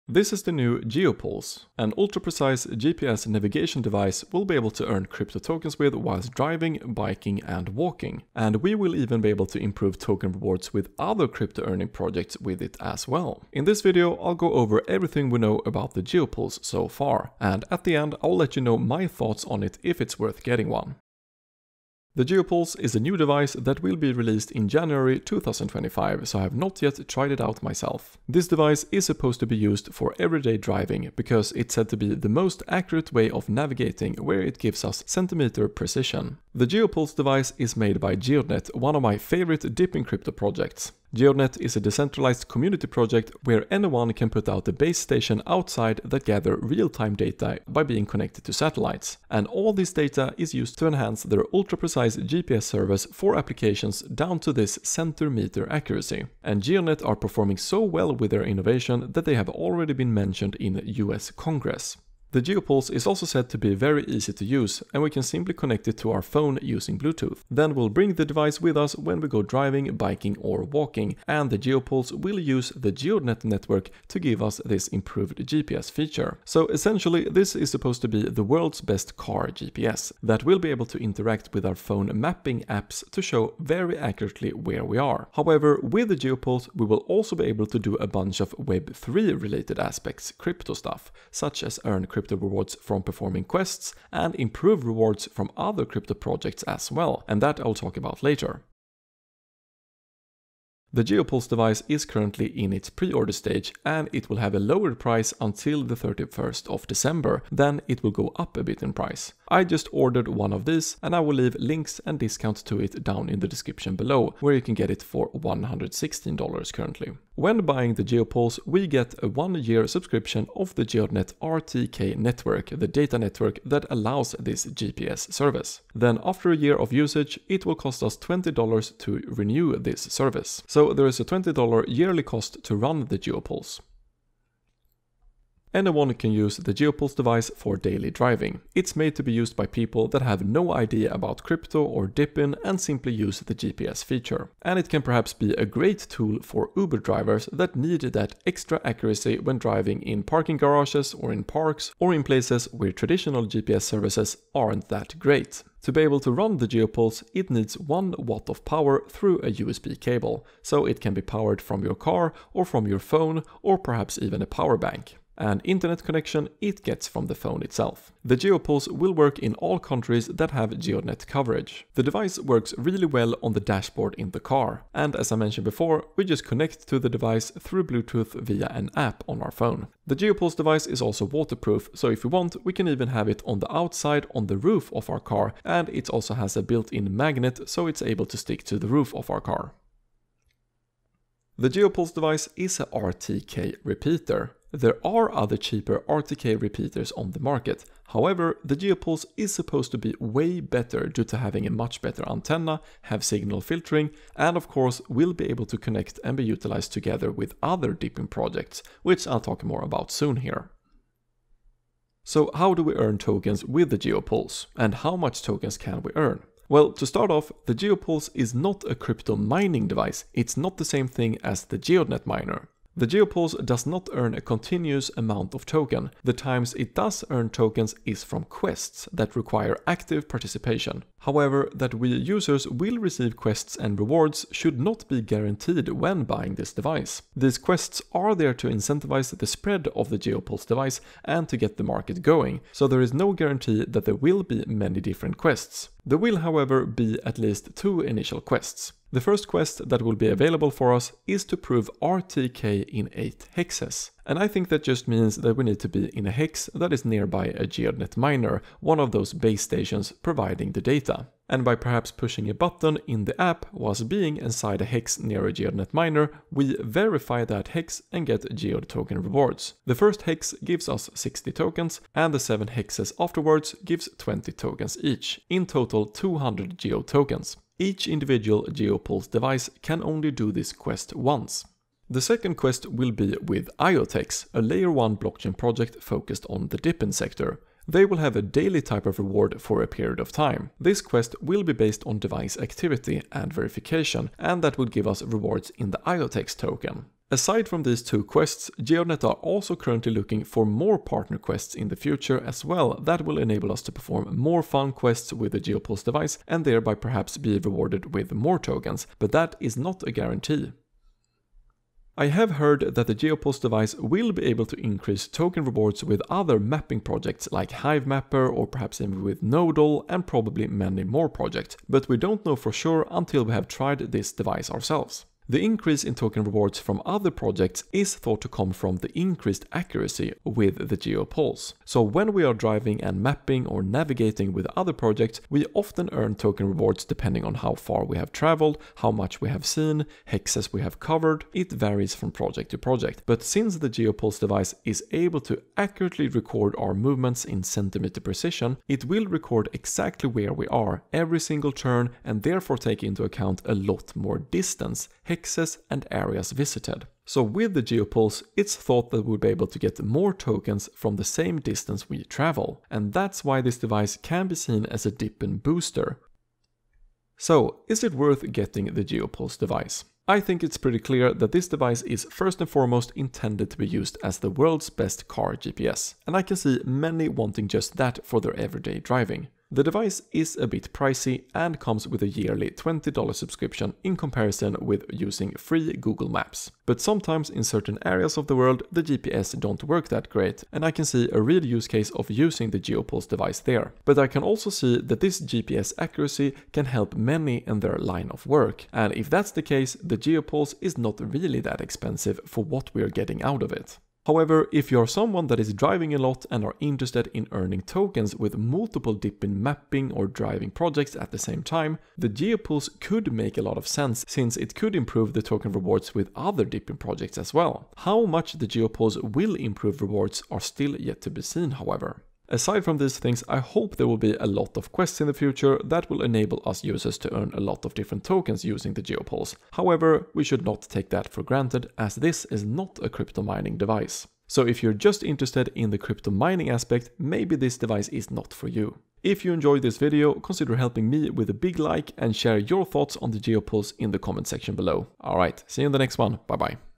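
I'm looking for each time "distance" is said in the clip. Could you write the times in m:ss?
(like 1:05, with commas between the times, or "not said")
5:54, 6:01.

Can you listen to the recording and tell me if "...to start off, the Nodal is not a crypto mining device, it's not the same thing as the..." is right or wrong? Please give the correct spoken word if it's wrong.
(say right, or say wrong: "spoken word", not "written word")
wrong: "Geopulse", not "Nodal".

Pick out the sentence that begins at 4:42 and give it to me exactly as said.
The second quest will be with IOTEX, a layer 1 blockchain project focused on the DePIN sector.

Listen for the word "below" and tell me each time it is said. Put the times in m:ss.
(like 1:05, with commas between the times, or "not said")
1:53, 7:24.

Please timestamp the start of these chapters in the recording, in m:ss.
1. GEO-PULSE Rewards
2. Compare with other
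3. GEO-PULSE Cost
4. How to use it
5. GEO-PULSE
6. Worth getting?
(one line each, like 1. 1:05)
1. 3:30
2. 3:09
3. 1:38
4. 2:13
5. 0:21
6. 6:06.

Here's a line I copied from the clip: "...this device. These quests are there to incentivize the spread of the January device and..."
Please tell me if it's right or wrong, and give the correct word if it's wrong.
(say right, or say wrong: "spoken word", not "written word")
wrong: "Geopulse", not "January".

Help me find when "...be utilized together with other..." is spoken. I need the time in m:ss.
3:26.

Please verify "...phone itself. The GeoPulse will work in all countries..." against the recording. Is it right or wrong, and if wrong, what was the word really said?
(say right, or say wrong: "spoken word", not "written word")
right.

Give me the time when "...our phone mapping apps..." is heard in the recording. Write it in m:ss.
1:21.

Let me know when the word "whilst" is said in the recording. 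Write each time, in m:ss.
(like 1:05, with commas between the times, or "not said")
0:05, 4:23.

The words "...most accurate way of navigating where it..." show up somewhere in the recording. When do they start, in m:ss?
0:32.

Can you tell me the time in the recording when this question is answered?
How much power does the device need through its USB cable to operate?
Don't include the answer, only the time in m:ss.
2:37.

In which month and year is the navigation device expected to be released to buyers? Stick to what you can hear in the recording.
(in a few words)
January 2025.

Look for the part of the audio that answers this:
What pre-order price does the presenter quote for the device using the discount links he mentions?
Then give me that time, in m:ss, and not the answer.
1:55.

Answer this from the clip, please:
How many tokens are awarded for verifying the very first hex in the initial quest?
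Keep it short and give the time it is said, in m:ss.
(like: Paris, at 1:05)
60, at 4:31.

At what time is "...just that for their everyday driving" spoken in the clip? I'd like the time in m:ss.
6:17.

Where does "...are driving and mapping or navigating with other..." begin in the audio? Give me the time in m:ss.
5:32.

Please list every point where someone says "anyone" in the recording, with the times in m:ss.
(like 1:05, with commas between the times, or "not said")
0:43, 2:15.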